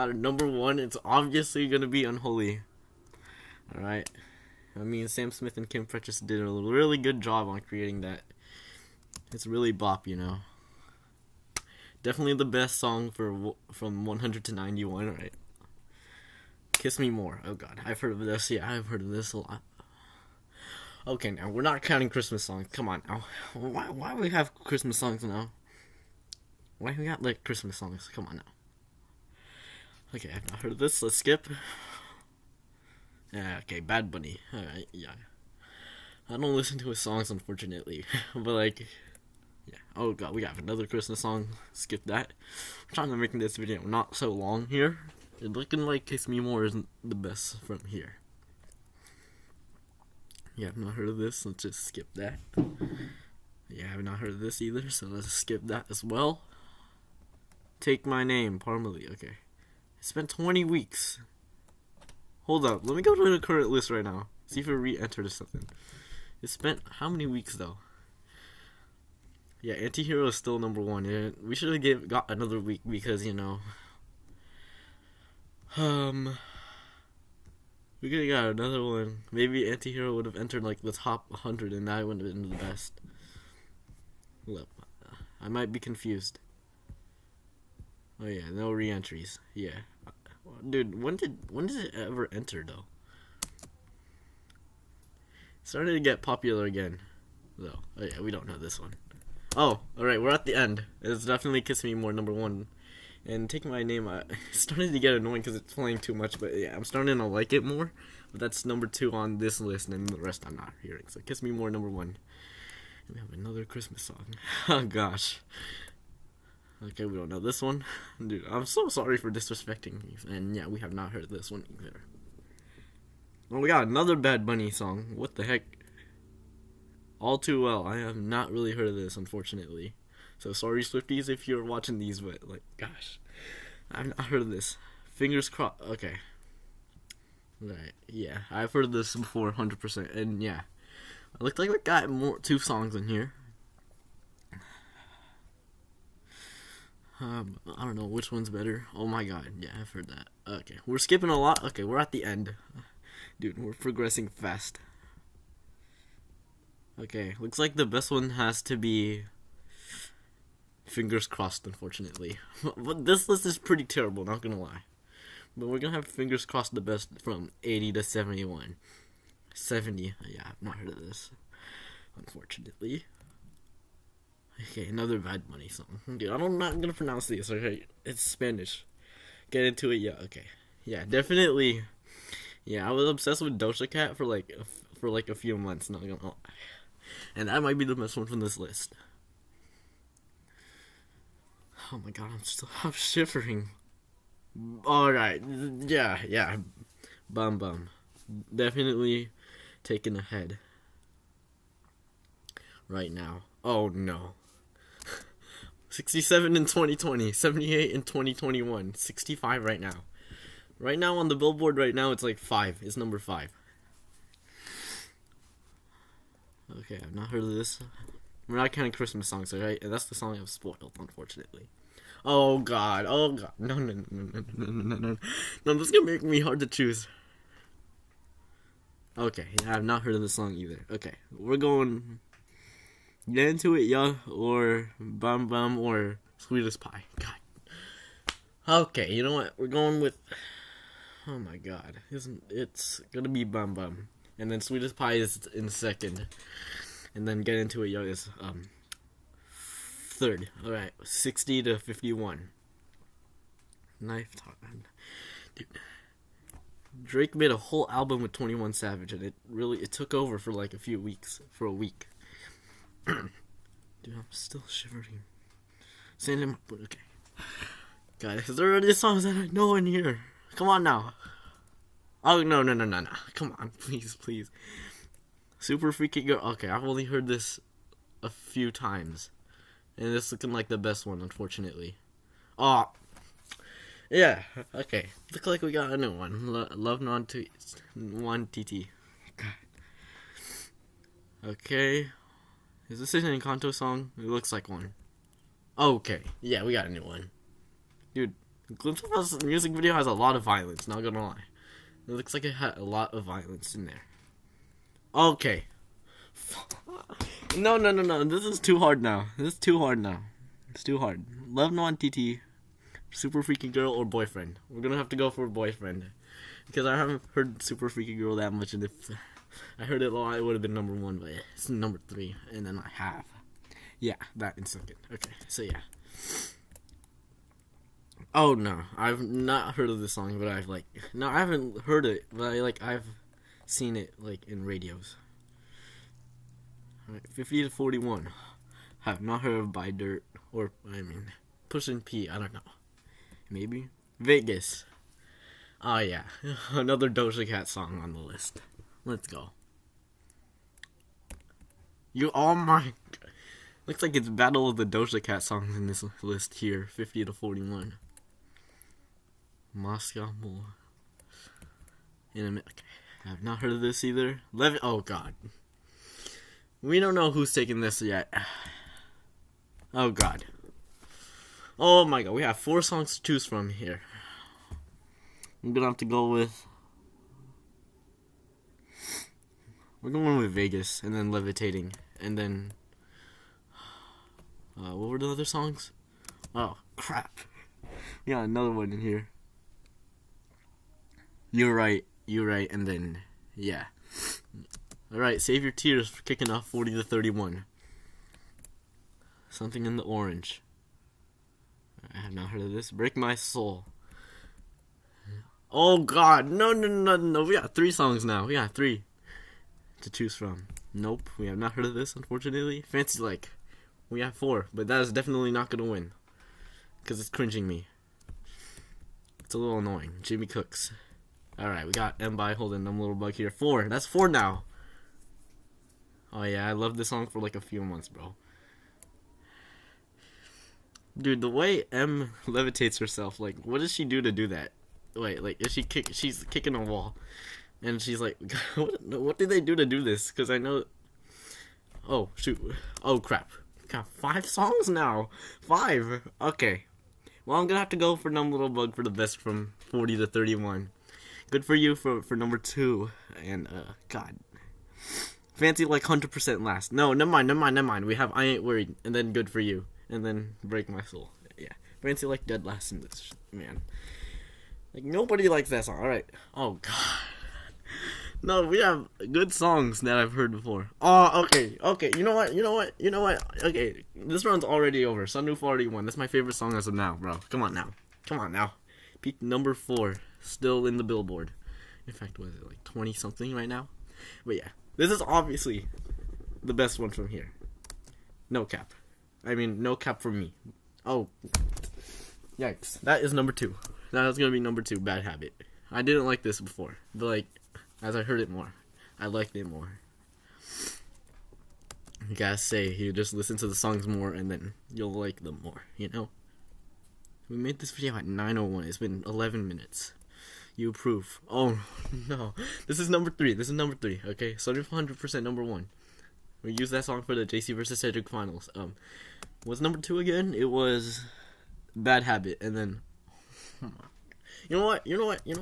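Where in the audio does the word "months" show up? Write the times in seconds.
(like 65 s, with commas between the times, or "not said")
185 s, 427 s.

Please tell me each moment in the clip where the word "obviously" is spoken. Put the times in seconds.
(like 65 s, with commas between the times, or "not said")
1 s, 485 s.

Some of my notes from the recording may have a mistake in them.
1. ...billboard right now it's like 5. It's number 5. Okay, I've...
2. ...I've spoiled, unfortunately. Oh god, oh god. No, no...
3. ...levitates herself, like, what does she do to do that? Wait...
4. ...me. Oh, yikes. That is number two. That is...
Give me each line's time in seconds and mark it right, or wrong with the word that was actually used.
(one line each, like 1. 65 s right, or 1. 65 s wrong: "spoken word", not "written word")
1. 211 s right
2. 220 s right
3. 432 s right
4. 490 s right.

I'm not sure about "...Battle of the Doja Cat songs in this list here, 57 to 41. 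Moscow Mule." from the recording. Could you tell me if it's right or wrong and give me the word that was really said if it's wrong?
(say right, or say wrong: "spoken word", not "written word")
wrong: "50", not "57".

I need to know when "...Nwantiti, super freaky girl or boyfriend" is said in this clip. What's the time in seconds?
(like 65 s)
311 s.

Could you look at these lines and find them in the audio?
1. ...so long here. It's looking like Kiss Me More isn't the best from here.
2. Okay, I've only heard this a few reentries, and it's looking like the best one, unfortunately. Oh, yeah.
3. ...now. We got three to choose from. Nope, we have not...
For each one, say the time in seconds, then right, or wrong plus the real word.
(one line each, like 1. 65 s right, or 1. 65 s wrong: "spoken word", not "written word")
1. 44 s right
2. 276 s wrong: "times", not "reentries"
3. 408 s right.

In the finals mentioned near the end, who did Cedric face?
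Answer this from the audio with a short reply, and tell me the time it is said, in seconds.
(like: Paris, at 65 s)
JC, at 517 s.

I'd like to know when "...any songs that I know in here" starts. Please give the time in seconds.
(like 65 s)
268 s.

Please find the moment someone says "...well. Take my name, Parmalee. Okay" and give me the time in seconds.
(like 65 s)
56 s.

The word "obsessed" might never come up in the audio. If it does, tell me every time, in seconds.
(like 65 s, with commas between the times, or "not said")
183 s.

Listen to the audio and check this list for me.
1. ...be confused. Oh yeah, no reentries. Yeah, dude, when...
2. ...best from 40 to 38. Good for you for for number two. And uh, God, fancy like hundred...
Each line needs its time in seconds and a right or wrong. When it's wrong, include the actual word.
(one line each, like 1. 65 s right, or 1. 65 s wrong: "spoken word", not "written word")
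1. 85 s right
2. 449 s wrong: "31", not "38".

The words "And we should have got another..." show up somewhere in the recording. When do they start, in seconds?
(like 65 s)
71 s.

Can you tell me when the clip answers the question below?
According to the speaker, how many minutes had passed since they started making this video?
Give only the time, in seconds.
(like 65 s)
509 s.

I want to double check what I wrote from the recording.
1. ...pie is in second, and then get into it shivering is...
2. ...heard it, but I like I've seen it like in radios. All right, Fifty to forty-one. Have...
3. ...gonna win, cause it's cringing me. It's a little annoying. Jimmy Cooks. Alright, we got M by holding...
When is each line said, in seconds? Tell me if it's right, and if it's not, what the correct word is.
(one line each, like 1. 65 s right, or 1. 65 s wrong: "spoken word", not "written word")
1. 244 s wrong: "young", not "shivering"
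2. 331 s right
3. 415 s right.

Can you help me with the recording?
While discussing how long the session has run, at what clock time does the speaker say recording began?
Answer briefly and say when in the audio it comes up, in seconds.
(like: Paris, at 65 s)
9:01, at 508 s.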